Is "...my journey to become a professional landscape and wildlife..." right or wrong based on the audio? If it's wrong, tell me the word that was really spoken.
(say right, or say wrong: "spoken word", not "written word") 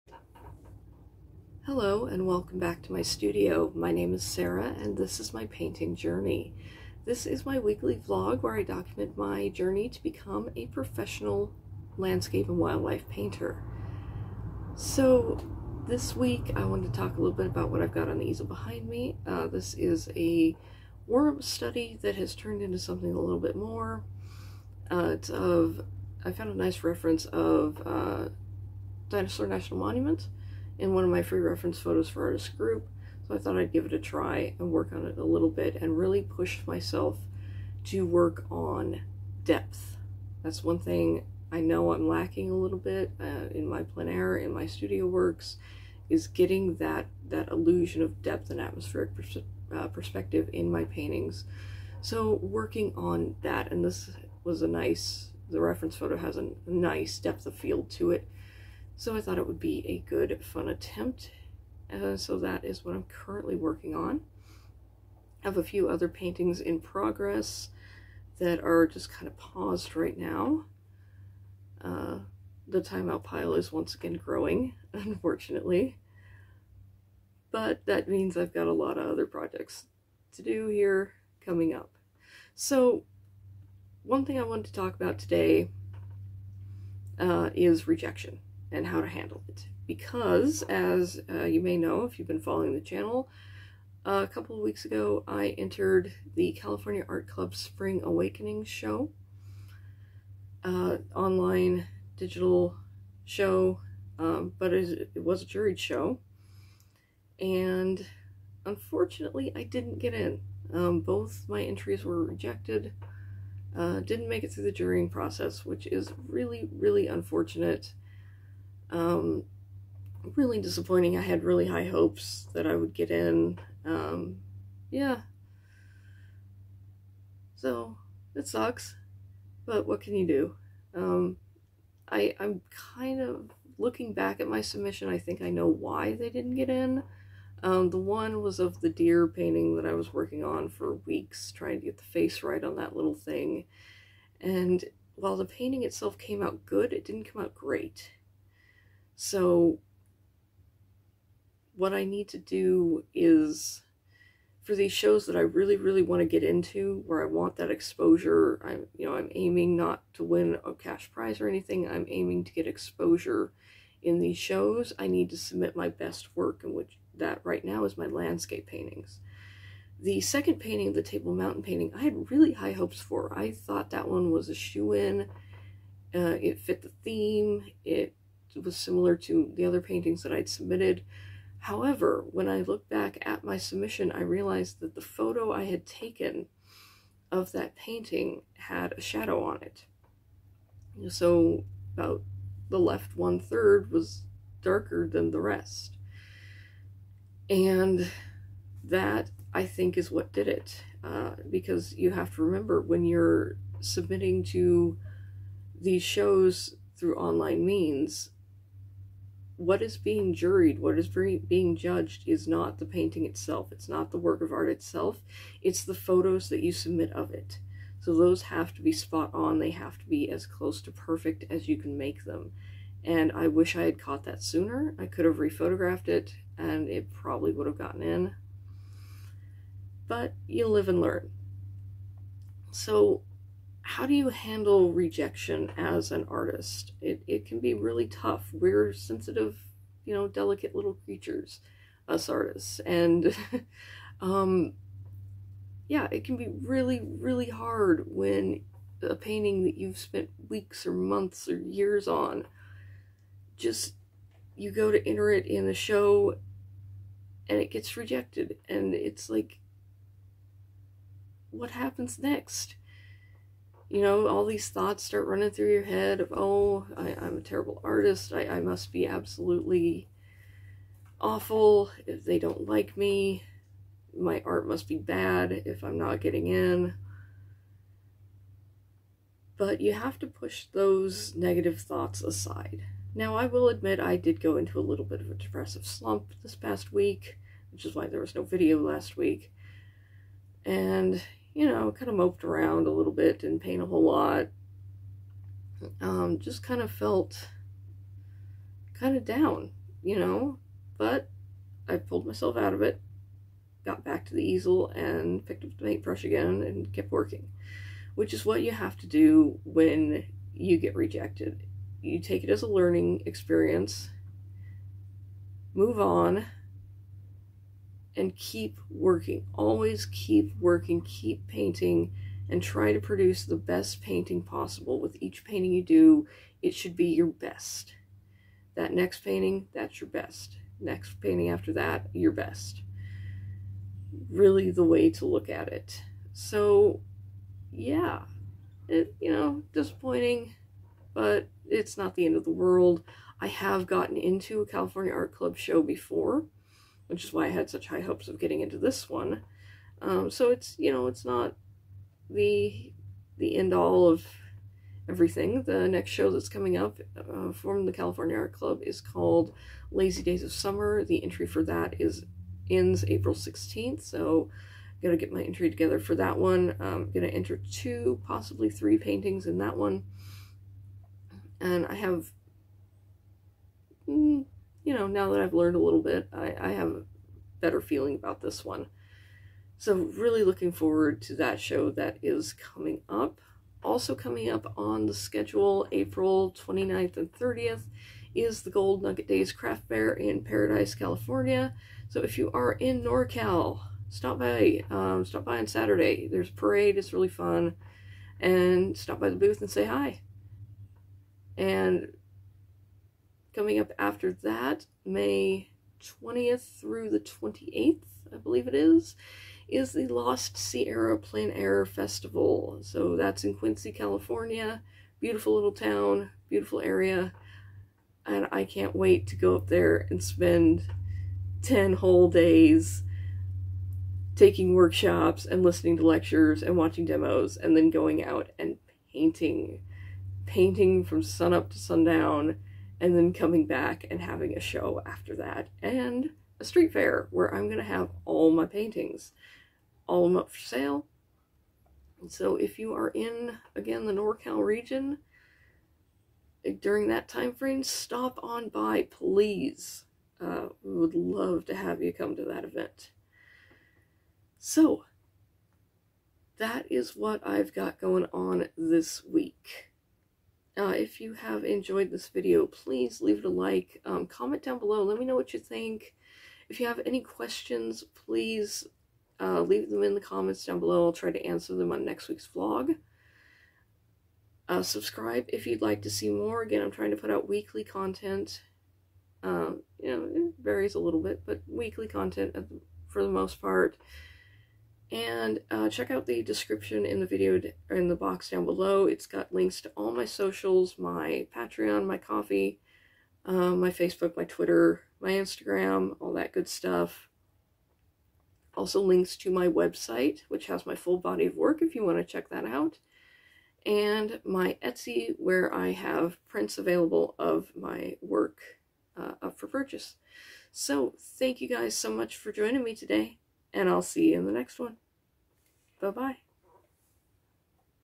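right.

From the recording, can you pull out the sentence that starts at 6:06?
I'm um, gonna enter two, possibly three paintings in that one.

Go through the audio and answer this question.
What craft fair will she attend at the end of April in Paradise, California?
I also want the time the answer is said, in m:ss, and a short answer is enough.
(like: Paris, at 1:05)
Gold Nugget Days Craft Fair, at 6:28.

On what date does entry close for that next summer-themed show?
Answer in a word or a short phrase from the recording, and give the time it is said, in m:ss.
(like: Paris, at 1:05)
April 16th, at 6:03.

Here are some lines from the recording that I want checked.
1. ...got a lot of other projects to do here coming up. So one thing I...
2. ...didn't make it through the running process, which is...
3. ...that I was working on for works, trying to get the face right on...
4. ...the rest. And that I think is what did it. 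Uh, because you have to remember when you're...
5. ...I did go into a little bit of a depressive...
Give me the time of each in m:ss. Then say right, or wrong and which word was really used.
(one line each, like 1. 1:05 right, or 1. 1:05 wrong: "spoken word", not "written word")
1. 1:18 right
2. 1:54 wrong: "jurying", not "running"
3. 2:19 wrong: "weeks", not "works"
4. 3:15 right
5. 4:43 right.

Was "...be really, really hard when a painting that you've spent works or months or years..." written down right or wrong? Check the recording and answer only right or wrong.
wrong.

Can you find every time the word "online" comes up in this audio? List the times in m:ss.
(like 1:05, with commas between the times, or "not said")
1:41, 3:27.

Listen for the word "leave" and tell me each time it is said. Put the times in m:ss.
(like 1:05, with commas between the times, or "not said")
7:43, 7:49.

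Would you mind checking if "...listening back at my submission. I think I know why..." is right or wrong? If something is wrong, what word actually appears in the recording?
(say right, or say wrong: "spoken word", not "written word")
wrong: "looking", not "listening".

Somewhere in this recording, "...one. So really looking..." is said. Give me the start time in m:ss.
6:18.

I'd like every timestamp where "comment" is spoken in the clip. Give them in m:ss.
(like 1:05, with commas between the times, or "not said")
7:44, 7:50.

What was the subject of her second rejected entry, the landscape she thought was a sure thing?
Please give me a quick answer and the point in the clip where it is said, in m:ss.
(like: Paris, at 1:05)
Table Mountain, at 2:51.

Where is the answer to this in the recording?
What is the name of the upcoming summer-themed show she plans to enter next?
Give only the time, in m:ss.
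5:59.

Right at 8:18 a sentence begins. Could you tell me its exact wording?
Also links to my website, which has my full body of work if you want to check that out.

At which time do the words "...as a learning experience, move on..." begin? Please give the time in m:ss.
5:12.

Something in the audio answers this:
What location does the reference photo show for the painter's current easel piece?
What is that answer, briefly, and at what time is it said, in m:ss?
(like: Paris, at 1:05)
Dinosaur National Monument, at 0:29.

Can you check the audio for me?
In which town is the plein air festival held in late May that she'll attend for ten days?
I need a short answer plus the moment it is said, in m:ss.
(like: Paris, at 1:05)
Quincy, California, at 6:53.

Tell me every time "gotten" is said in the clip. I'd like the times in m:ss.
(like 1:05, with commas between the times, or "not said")
3:47, 5:43.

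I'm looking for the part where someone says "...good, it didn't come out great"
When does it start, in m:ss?
2:26.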